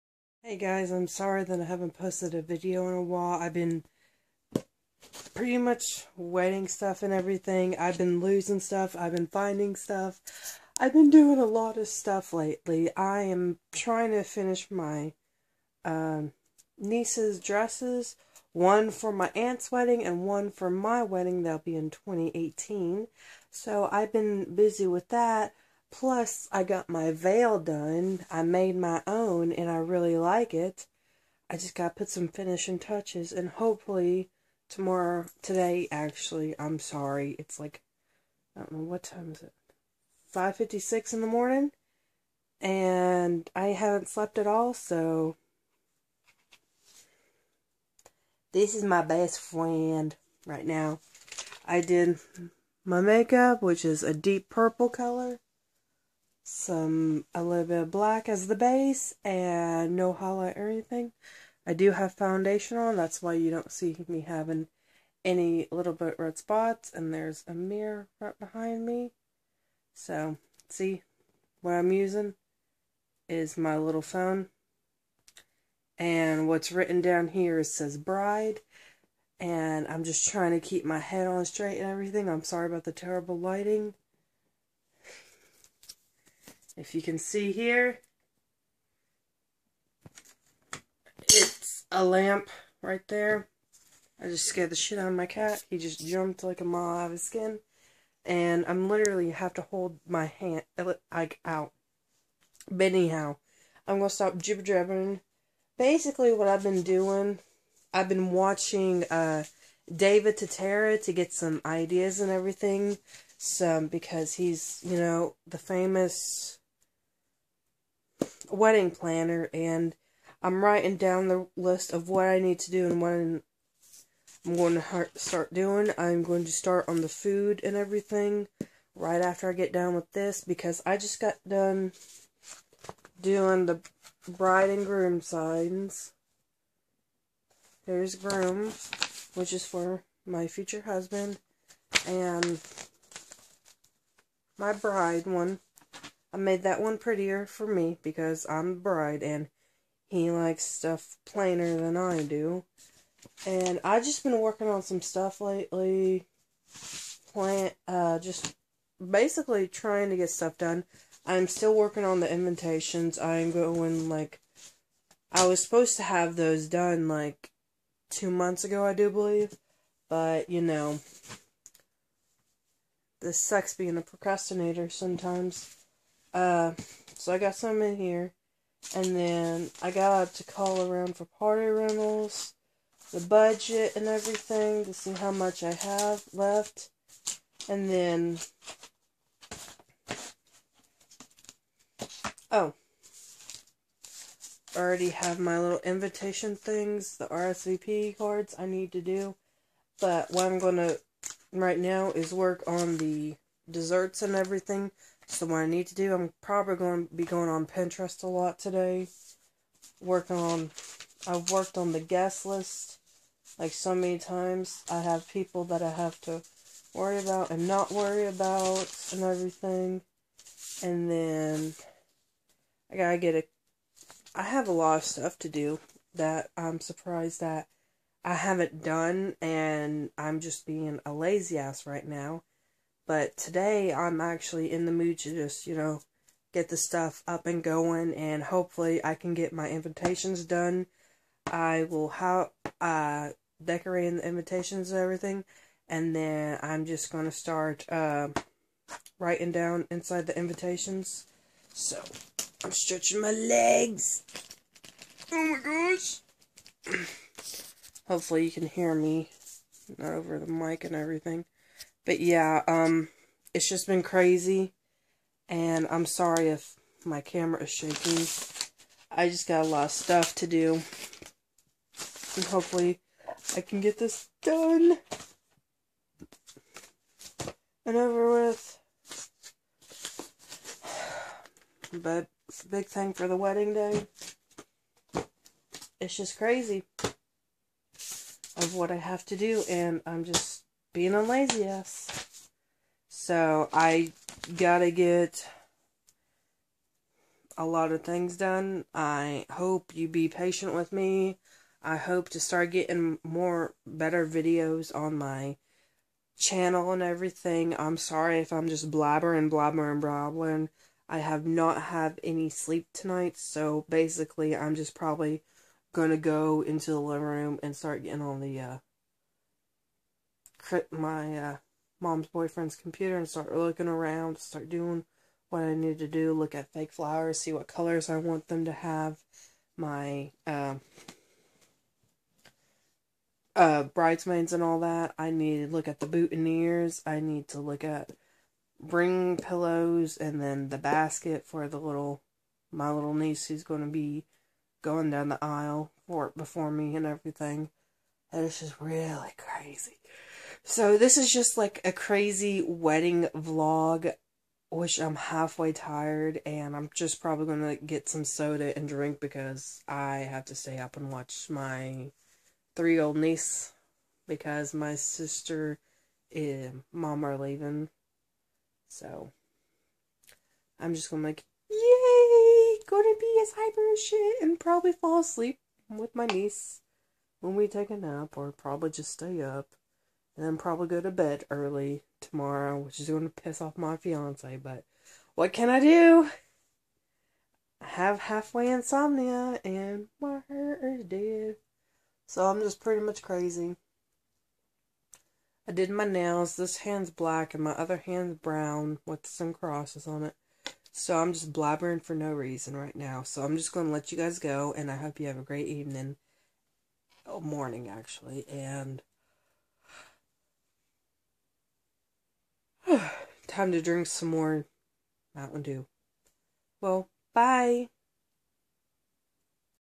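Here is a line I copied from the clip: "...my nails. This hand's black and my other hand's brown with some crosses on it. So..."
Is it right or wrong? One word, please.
right.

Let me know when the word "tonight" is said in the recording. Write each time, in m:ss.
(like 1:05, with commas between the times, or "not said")
5:12.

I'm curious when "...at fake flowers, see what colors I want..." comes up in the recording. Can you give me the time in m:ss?
5:26.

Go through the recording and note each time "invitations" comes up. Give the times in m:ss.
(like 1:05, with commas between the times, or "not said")
2:42, 3:15, 3:59, 4:04, 4:10.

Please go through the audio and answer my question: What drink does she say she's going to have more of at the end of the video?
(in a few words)
Mountain Dew.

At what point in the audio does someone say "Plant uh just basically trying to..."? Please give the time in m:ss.
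2:37.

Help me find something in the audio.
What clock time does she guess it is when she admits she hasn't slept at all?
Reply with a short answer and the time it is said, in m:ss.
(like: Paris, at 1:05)
5:56, at 0:40.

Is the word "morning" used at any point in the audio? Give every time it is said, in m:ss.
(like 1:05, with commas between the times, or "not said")
0:41, 6:47.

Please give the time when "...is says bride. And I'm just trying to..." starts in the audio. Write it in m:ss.
1:17.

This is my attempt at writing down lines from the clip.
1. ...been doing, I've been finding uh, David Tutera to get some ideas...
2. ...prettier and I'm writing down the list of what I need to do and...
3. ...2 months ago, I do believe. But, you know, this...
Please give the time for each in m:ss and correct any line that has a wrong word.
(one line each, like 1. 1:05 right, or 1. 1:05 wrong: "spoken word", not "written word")
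1. 1:46 wrong: "watching", not "finding"
2. 1:58 wrong: "planner", not "prettier"
3. 2:48 right.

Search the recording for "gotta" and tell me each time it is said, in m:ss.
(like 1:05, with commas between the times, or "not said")
3:42, 4:54.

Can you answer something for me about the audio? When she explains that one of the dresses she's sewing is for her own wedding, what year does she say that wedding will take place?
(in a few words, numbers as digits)
2018.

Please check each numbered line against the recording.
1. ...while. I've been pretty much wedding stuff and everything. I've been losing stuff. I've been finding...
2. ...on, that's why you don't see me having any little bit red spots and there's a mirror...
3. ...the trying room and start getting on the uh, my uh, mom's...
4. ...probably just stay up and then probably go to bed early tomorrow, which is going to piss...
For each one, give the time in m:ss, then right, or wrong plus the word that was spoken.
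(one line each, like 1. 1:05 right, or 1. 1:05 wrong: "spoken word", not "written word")
1. 0:03 right
2. 1:02 right
3. 5:16 wrong: "living", not "trying"
4. 6:18 right.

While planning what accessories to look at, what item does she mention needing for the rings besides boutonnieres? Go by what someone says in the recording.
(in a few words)
ring pillows.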